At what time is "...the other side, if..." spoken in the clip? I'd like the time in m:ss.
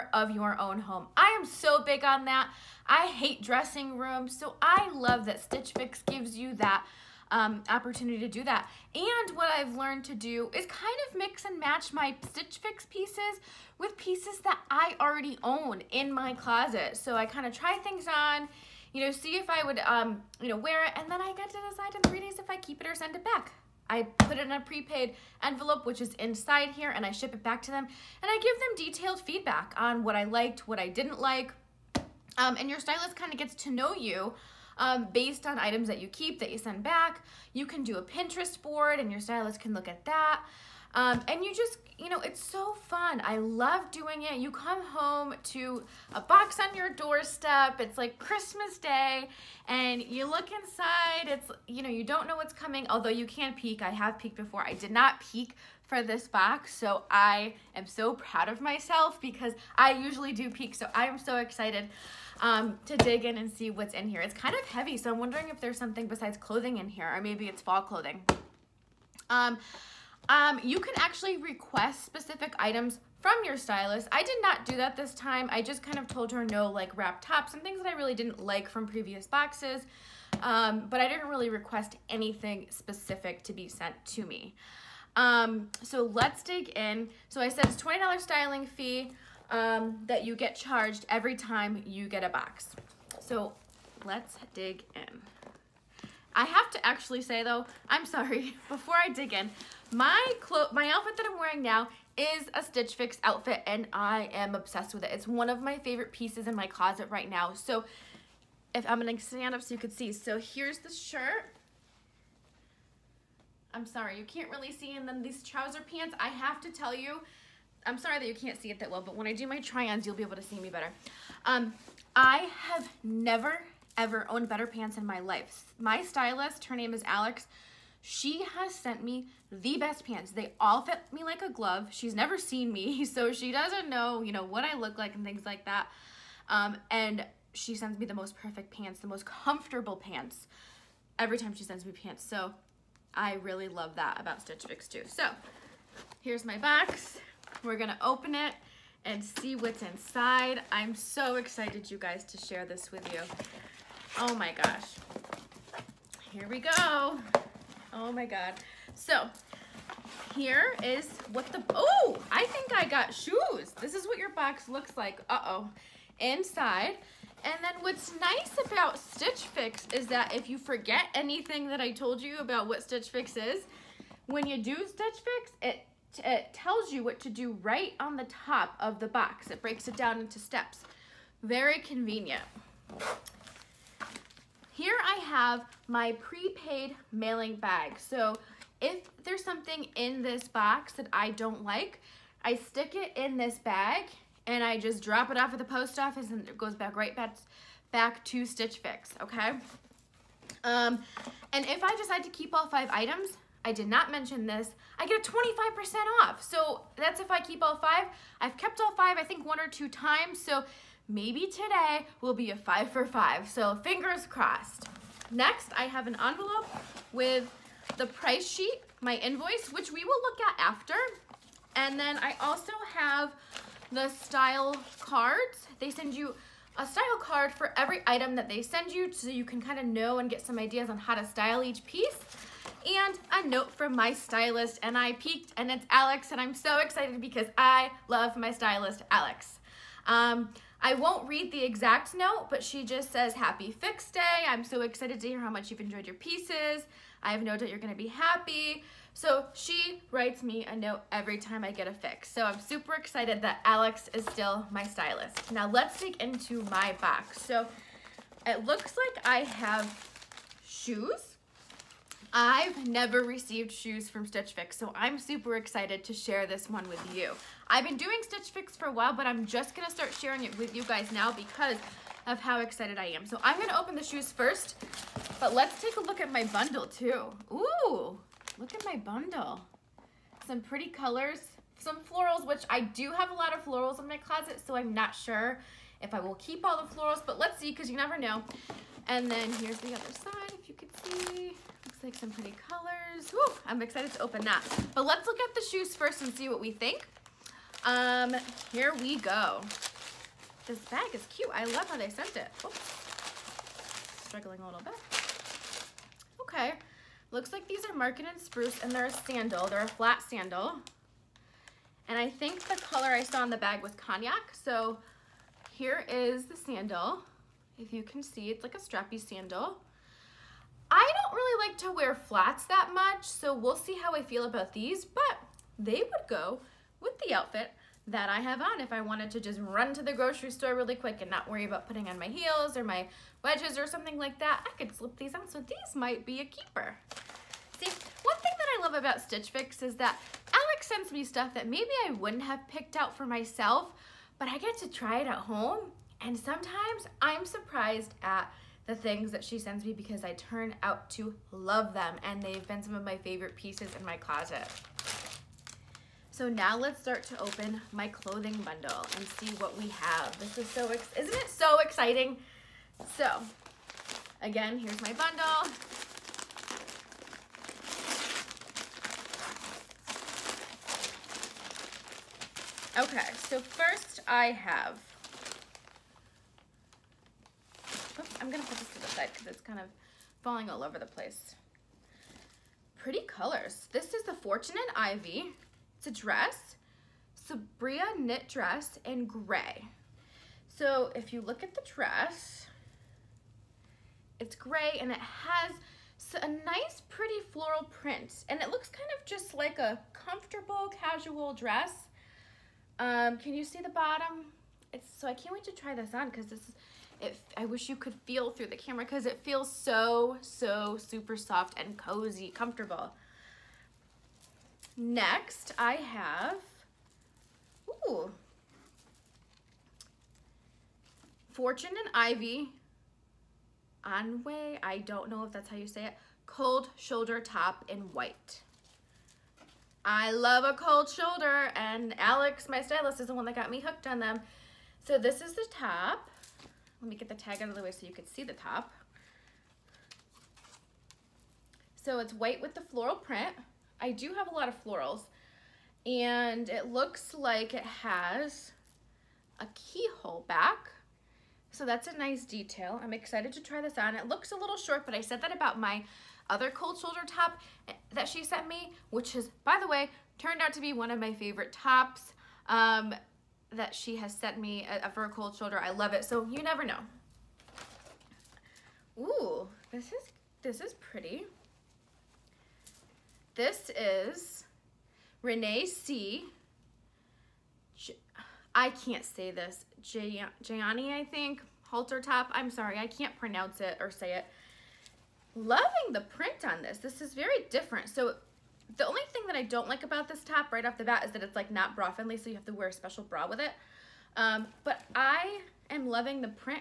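4:49.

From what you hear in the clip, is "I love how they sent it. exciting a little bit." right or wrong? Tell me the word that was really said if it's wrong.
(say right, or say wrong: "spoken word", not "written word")
wrong: "struggling", not "exciting".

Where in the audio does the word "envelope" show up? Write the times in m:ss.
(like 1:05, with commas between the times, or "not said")
0:25, 3:36.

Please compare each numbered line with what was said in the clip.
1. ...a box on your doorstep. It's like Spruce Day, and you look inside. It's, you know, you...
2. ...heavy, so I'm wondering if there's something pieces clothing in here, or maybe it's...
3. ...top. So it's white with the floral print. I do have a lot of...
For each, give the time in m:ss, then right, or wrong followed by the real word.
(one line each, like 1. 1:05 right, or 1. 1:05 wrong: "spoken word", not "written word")
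1. 0:46 wrong: "Christmas", not "Spruce"
2. 1:04 wrong: "besides", not "pieces"
3. 7:18 right.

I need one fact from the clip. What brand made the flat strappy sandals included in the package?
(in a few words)
Market and Spruce.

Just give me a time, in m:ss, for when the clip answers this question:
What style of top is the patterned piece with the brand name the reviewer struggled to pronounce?
8:01.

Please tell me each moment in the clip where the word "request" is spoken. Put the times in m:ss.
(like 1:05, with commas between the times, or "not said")
1:11, 1:21.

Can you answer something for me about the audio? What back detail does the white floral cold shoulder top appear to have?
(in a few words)
keyhole back.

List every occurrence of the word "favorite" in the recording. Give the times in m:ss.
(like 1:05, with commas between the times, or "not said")
1:45, 5:53, 7:41.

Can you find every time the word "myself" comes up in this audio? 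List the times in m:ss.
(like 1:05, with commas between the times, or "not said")
0:58, 5:43.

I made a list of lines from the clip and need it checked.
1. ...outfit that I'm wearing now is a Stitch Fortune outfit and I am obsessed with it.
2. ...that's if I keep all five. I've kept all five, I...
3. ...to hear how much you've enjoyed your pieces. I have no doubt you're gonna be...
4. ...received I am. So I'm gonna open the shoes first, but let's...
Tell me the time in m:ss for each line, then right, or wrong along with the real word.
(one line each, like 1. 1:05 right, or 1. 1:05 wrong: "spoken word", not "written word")
1. 1:40 wrong: "Fix", not "Fortune"
2. 3:26 right
3. 4:05 right
4. 4:32 wrong: "excited", not "received".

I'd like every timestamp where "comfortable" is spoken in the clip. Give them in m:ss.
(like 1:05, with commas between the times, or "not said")
2:19, 6:40, 6:52.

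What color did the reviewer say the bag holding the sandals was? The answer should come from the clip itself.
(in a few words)
cognac.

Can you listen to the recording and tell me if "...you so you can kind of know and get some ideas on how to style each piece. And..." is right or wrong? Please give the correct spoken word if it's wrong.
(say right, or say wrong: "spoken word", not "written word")
right.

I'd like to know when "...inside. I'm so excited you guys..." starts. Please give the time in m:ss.
2:29.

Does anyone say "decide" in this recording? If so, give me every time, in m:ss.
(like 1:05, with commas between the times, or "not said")
0:21, 3:21.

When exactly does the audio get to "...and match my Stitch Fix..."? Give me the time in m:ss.
0:11.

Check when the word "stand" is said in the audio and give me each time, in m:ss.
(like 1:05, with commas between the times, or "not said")
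1:49.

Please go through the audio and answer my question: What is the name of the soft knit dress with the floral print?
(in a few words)
Sabria.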